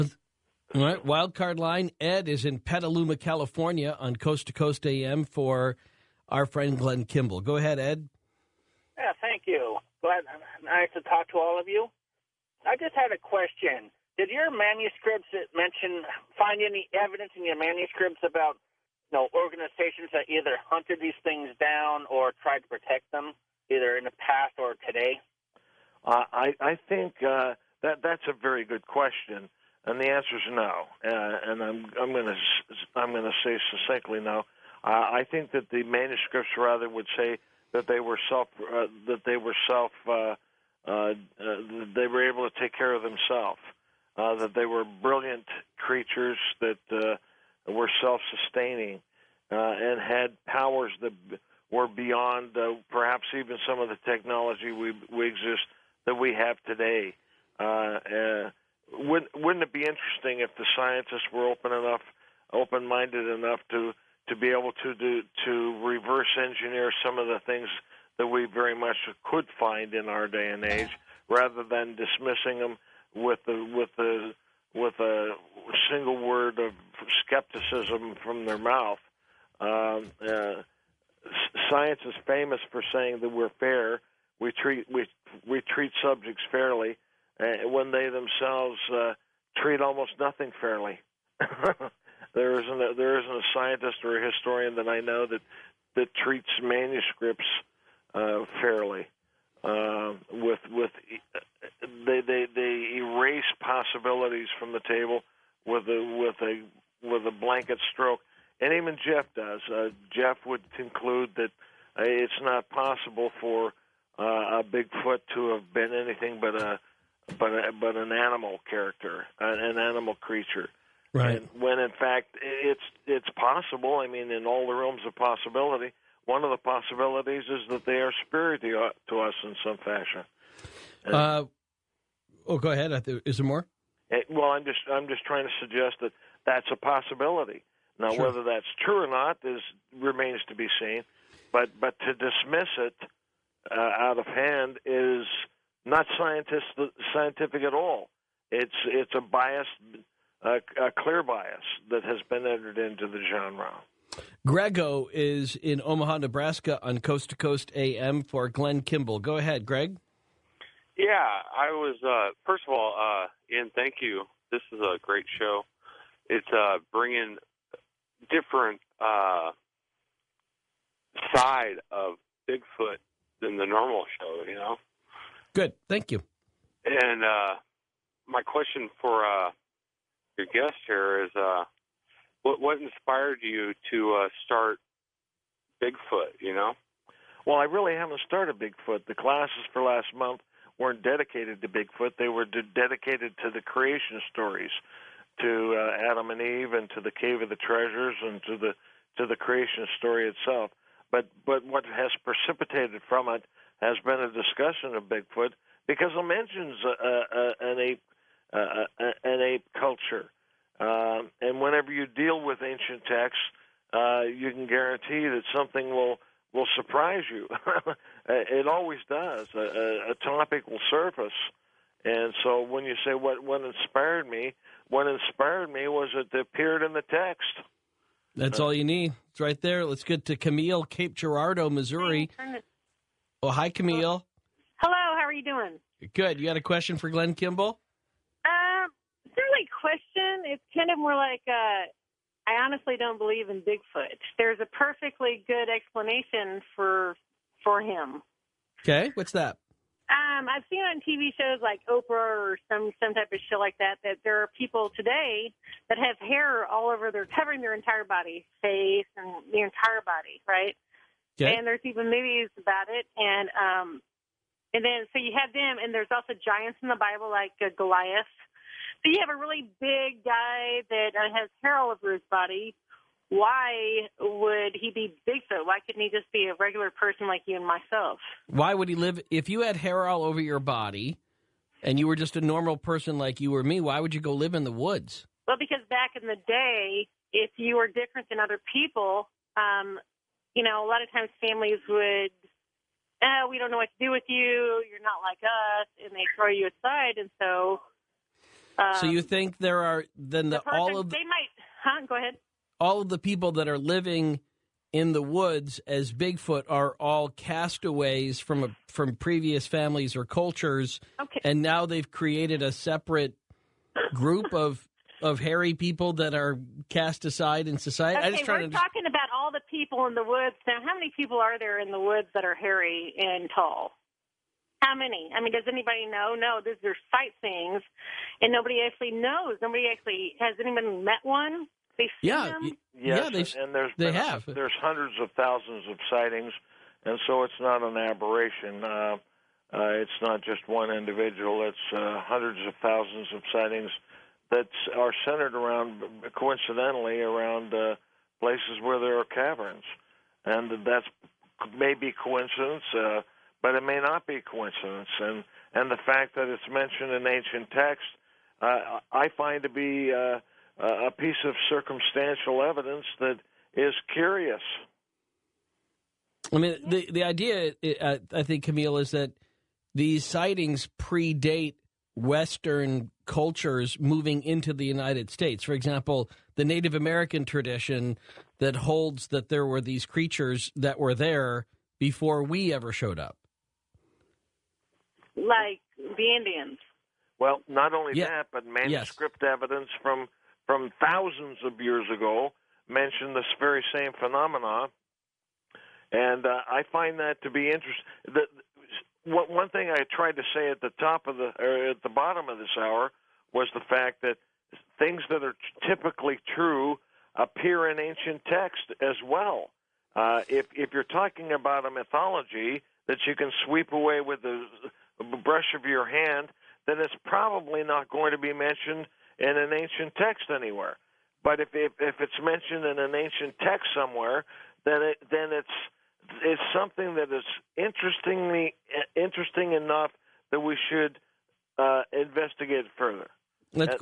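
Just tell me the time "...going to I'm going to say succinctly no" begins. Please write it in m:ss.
0:32.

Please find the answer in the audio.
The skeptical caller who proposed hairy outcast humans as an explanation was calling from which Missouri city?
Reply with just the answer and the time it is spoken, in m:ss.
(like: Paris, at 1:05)
Cape Girardeau, at 3:50.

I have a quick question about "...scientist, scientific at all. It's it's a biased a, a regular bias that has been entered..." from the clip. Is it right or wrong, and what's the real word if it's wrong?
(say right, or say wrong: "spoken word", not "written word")
wrong: "clear", not "regular".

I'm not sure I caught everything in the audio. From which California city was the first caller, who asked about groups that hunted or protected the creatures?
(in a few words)
Petaluma.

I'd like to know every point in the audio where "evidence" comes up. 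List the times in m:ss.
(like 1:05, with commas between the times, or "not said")
0:16, 6:02, 6:29.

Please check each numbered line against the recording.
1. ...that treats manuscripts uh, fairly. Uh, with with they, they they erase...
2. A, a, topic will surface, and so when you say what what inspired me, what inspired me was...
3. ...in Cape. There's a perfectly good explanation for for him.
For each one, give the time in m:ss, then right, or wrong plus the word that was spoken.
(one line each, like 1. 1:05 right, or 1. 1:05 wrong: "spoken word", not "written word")
1. 1:35 right
2. 3:39 right
3. 4:03 wrong: "Bigfoot", not "Cape".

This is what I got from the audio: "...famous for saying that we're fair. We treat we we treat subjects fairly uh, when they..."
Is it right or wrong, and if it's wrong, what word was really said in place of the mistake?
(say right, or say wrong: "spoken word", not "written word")
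right.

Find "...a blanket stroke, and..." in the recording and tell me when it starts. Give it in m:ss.
1:47.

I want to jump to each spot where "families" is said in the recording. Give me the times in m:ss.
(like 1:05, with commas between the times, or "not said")
4:51, 5:09.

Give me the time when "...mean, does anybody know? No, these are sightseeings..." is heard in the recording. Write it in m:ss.
5:25.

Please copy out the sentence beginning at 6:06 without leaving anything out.
I mean, the the idea uh, I think Camille is that these sightings predate Western cultures moving into the United States.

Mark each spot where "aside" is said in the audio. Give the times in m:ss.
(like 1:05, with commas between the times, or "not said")
4:56, 5:17.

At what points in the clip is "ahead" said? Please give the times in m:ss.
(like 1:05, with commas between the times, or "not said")
0:07, 2:12, 2:39, 5:02.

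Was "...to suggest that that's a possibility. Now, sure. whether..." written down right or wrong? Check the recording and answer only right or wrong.
right.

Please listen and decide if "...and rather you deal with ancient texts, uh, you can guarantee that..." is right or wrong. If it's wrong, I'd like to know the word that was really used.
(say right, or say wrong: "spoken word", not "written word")
wrong: "whenever", not "rather".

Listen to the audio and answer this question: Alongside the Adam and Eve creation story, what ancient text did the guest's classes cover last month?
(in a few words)
Cave of the Treasures.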